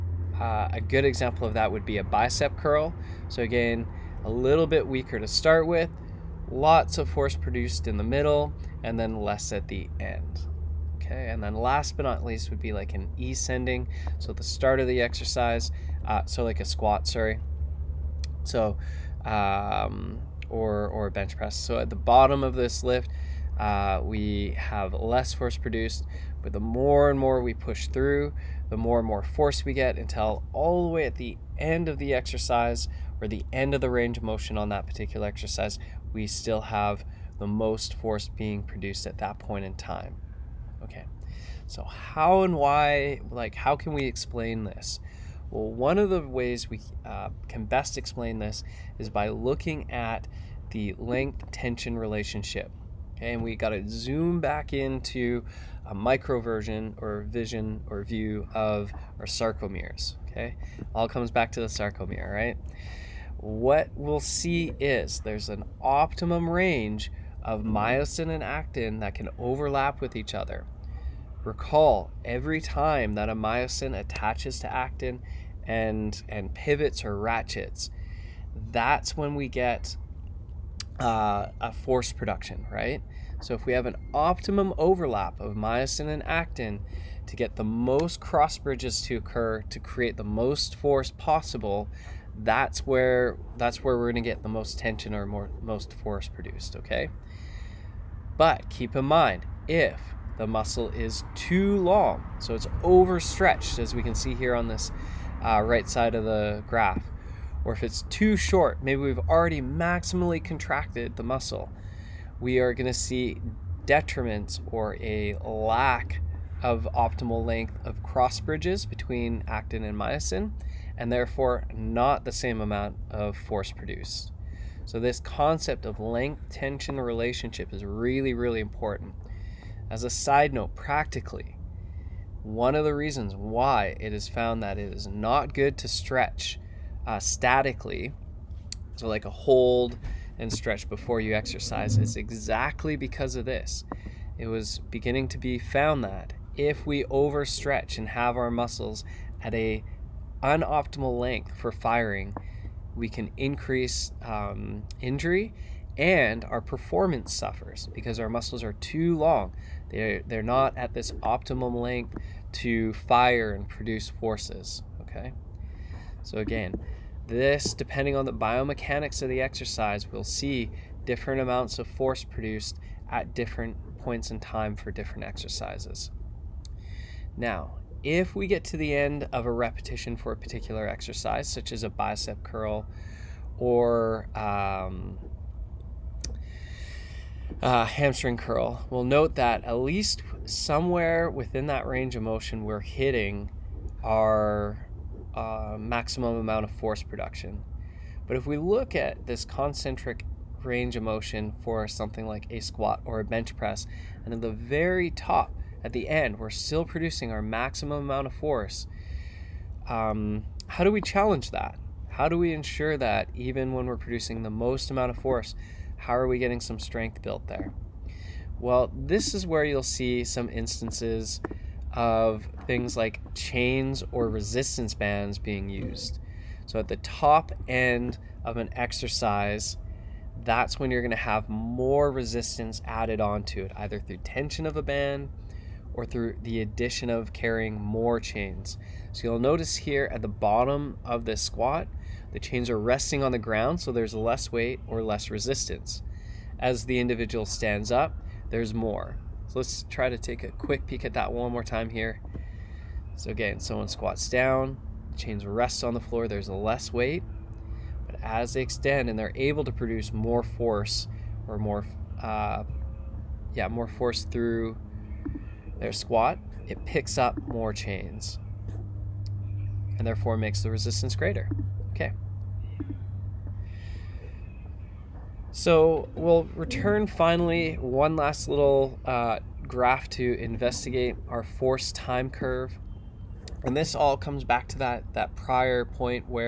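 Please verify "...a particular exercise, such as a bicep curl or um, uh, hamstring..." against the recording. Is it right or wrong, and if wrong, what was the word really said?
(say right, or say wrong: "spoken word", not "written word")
right.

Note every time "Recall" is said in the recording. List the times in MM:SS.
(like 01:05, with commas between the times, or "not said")
01:11.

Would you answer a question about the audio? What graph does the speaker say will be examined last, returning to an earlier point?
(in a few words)
Force time curve.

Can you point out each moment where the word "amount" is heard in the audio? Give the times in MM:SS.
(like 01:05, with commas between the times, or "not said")
02:02, 02:51, 03:16, 03:28, 03:34.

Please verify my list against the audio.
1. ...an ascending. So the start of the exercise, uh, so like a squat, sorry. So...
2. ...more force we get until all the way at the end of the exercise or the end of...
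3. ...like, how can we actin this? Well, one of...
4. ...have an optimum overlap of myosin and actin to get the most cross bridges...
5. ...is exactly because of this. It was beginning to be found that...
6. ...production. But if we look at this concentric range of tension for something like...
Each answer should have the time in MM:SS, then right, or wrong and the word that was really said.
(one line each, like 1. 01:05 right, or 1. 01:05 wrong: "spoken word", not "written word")
1. 00:12 right
2. 00:29 right
3. 00:43 wrong: "explain", not "actin"
4. 01:23 right
5. 02:21 right
6. 03:17 wrong: "motion", not "tension".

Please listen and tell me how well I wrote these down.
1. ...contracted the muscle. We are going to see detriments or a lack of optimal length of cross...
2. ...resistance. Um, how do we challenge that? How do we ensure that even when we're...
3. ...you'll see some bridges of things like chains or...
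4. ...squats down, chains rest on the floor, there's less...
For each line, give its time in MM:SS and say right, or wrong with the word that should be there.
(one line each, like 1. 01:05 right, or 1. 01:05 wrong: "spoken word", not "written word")
1. 01:50 right
2. 03:28 wrong: "force", not "resistance"
3. 03:39 wrong: "instances", not "bridges"
4. 04:13 right.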